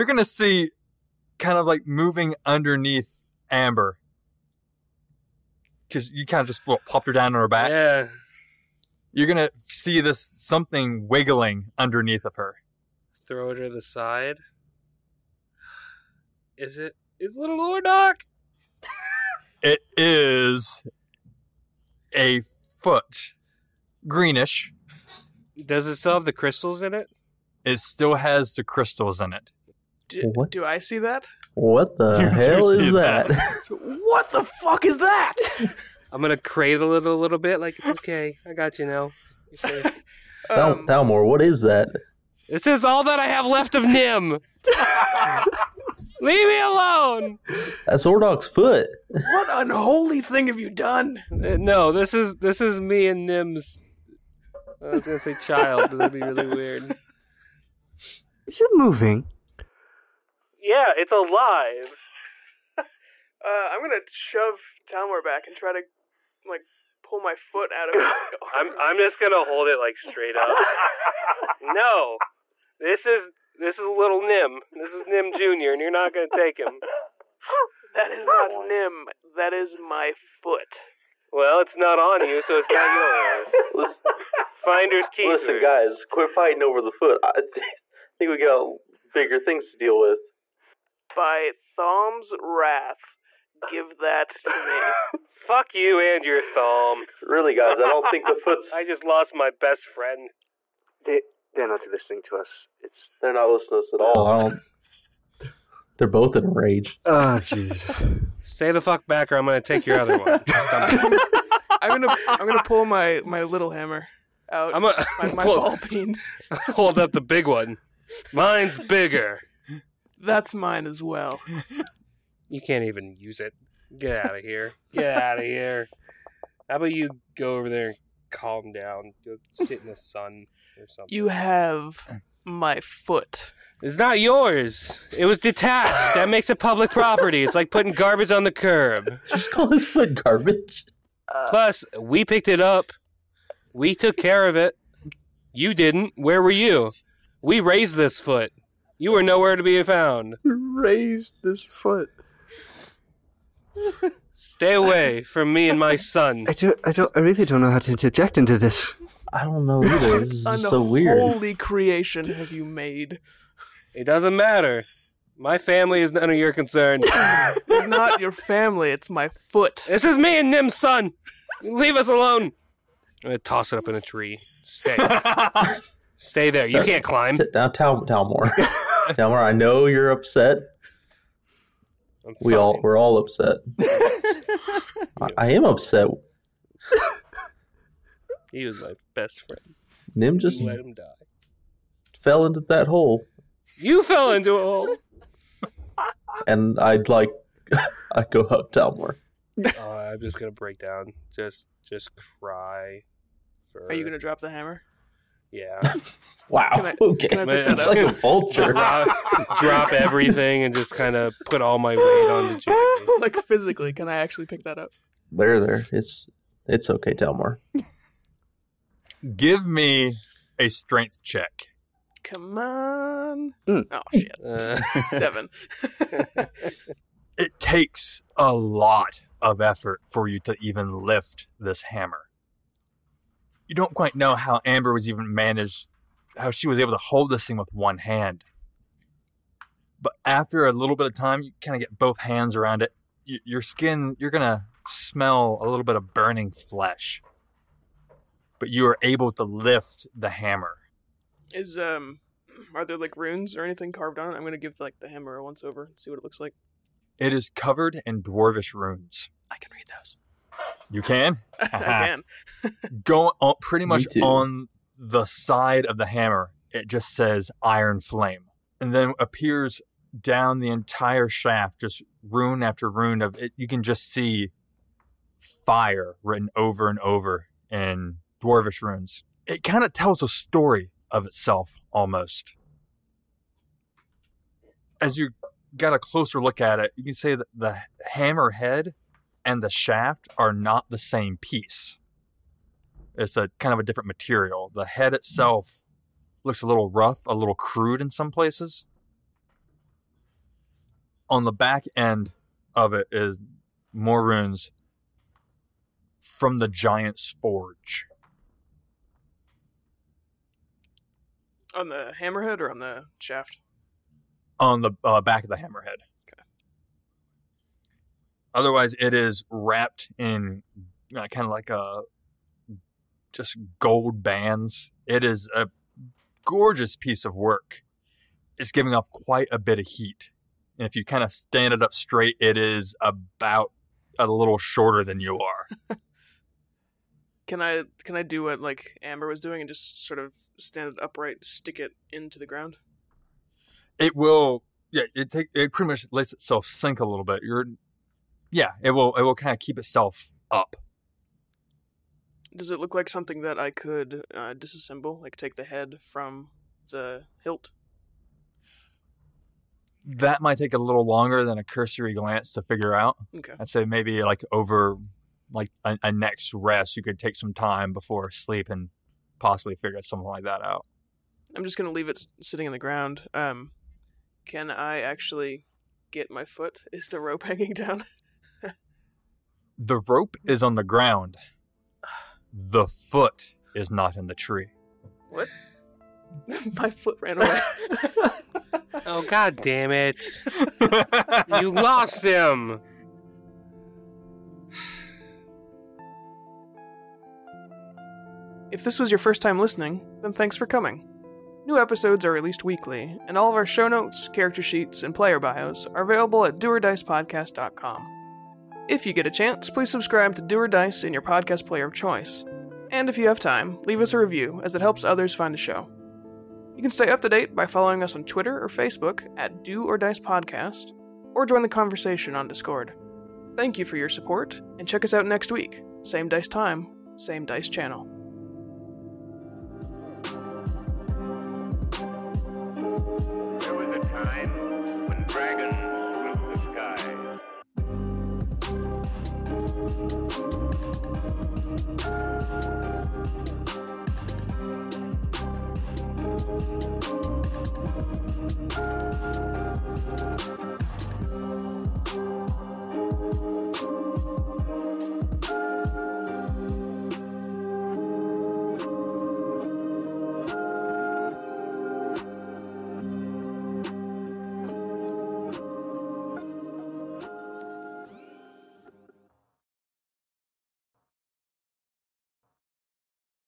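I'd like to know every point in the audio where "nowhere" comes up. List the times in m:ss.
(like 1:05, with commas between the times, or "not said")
2:29.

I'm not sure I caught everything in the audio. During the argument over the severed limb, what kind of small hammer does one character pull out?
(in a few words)
Ball peen.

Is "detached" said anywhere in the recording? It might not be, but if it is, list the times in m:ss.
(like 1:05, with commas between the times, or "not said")
2:15.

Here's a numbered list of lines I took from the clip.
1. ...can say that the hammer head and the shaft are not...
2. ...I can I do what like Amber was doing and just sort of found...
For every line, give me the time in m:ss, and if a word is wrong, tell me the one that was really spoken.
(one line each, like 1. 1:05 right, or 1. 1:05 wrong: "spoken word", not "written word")
1. 4:47 right
2. 5:37 wrong: "stand", not "found".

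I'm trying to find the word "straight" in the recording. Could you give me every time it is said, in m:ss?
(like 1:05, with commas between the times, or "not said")
1:09, 5:31.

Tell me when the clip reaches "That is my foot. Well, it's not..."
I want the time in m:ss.
1:19.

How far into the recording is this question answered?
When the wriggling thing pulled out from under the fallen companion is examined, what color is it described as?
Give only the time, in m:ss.
0:24.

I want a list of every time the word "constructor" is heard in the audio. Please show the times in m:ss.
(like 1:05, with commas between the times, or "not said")
not said.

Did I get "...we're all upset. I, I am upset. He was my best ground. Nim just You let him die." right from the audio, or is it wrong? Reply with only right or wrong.
wrong.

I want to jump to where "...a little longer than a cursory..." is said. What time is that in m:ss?
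6:00.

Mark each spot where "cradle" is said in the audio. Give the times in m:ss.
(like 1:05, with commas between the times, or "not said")
0:36.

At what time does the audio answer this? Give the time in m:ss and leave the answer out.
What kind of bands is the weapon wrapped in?
5:23.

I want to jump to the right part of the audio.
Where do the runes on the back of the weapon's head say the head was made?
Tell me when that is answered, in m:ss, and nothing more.
5:06.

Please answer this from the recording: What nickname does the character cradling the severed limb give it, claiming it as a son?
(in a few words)
Nim Junior.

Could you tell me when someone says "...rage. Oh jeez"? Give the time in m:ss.
1:46.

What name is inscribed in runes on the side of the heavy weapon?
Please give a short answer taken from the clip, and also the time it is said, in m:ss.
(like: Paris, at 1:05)
Iron Flame, at 4:27.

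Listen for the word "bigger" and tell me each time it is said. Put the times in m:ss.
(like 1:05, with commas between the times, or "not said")
1:29, 1:58.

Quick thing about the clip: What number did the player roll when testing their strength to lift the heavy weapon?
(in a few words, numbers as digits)
7.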